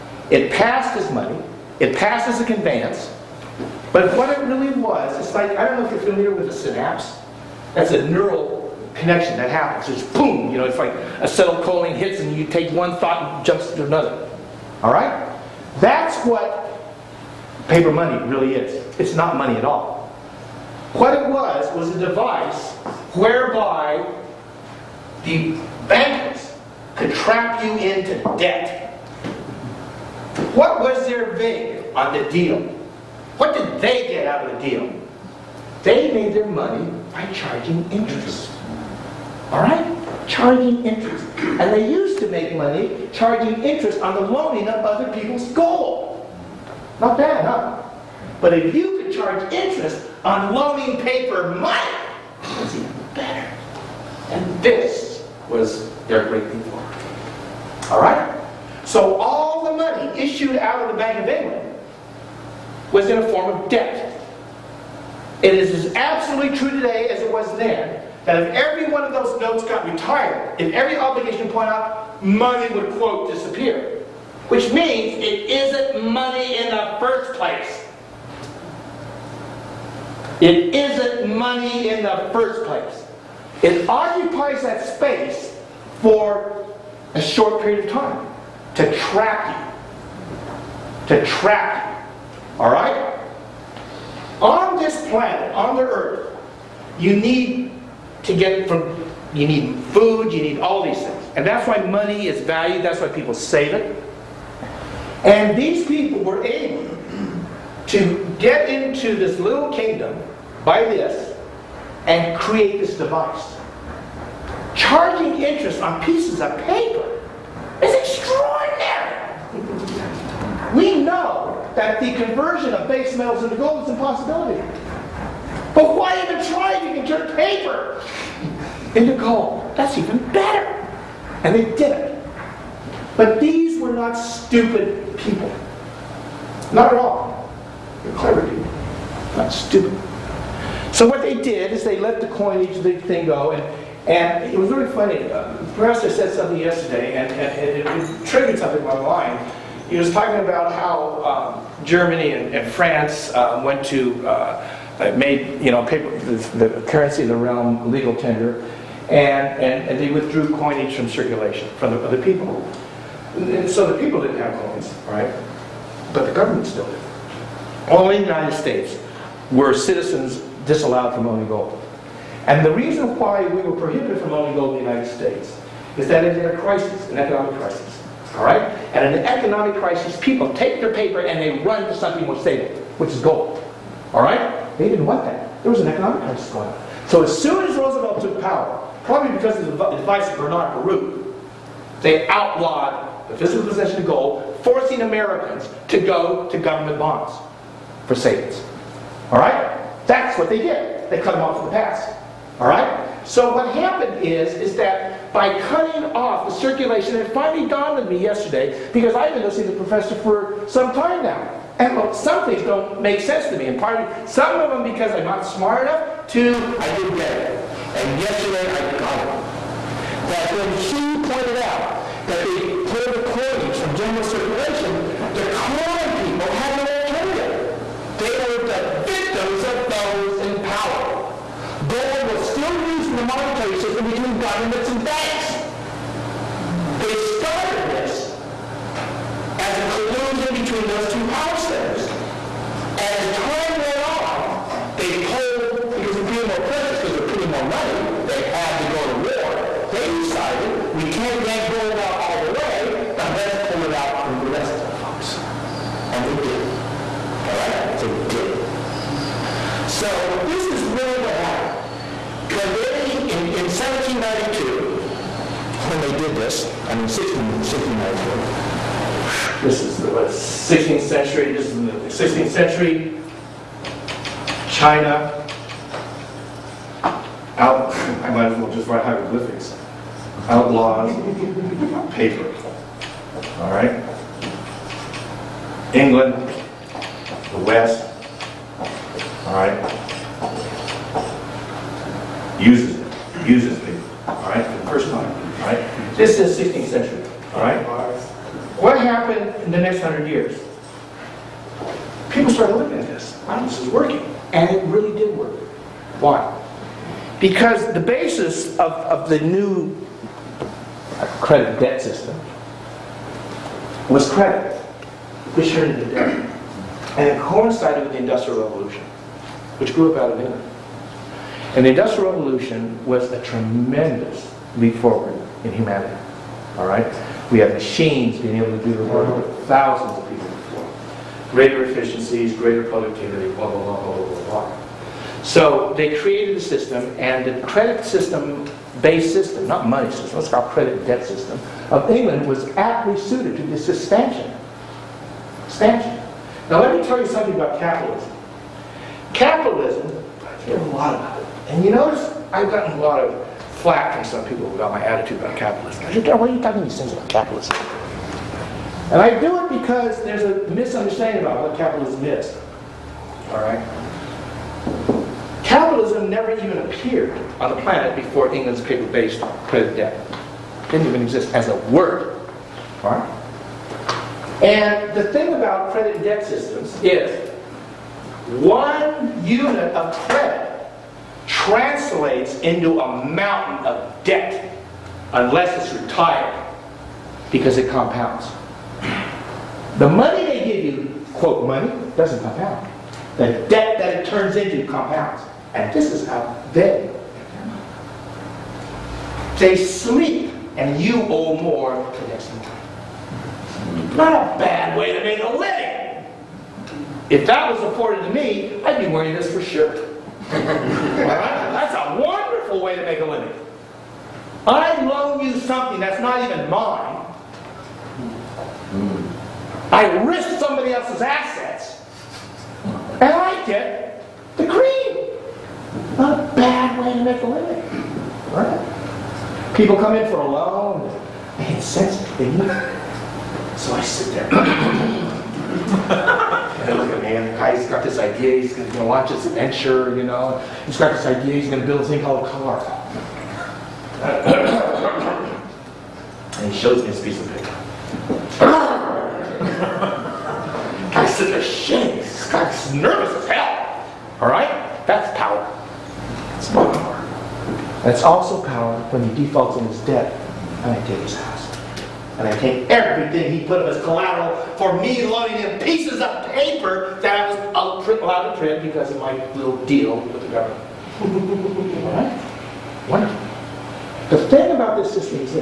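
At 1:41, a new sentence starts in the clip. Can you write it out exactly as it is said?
And that's why money is valued, that's why people save it.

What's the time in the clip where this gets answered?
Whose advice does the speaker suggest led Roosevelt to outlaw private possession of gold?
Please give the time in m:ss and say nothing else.
3:10.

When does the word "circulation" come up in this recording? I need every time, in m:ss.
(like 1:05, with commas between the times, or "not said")
2:41, 3:26, 3:44.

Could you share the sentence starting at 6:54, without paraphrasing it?
I loan you something that's not even mine.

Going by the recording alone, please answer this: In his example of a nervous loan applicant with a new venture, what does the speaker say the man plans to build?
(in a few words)
a car.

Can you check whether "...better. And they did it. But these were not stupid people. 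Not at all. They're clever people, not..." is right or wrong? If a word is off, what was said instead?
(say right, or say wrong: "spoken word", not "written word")
right.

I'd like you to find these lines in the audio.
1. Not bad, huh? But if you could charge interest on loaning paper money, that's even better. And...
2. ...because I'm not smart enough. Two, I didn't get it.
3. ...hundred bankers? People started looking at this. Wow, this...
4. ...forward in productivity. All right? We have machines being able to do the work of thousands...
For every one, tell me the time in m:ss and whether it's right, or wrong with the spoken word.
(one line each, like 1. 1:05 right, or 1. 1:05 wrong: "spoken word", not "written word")
1. 0:46 right
2. 3:34 right
3. 5:00 wrong: "years", not "bankers"
4. 5:24 wrong: "humanity", not "productivity".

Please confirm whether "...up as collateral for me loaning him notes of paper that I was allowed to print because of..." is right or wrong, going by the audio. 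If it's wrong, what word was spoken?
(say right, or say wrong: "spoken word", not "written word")
wrong: "pieces", not "notes".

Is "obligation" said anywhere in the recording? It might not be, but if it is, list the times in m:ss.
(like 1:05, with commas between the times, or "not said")
1:10.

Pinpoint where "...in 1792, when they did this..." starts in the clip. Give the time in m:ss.
4:23.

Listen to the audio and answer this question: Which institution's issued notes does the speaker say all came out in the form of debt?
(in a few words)
Bank of England.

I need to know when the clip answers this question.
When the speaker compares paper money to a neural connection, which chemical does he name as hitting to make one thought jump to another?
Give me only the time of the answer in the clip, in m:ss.
0:11.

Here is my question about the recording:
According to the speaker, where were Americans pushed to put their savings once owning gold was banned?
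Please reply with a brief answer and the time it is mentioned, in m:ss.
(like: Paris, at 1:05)
government bonds, at 3:16.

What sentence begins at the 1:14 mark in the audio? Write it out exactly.
Which means it isn't money in the first place.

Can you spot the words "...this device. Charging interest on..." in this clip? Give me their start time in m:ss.
1:52.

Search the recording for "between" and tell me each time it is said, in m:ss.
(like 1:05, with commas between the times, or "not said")
3:54, 4:00.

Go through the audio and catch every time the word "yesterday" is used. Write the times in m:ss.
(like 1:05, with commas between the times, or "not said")
2:26, 3:28, 3:38.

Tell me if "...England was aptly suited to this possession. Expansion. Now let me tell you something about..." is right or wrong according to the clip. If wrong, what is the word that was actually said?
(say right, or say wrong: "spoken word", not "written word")
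wrong: "expansion", not "possession".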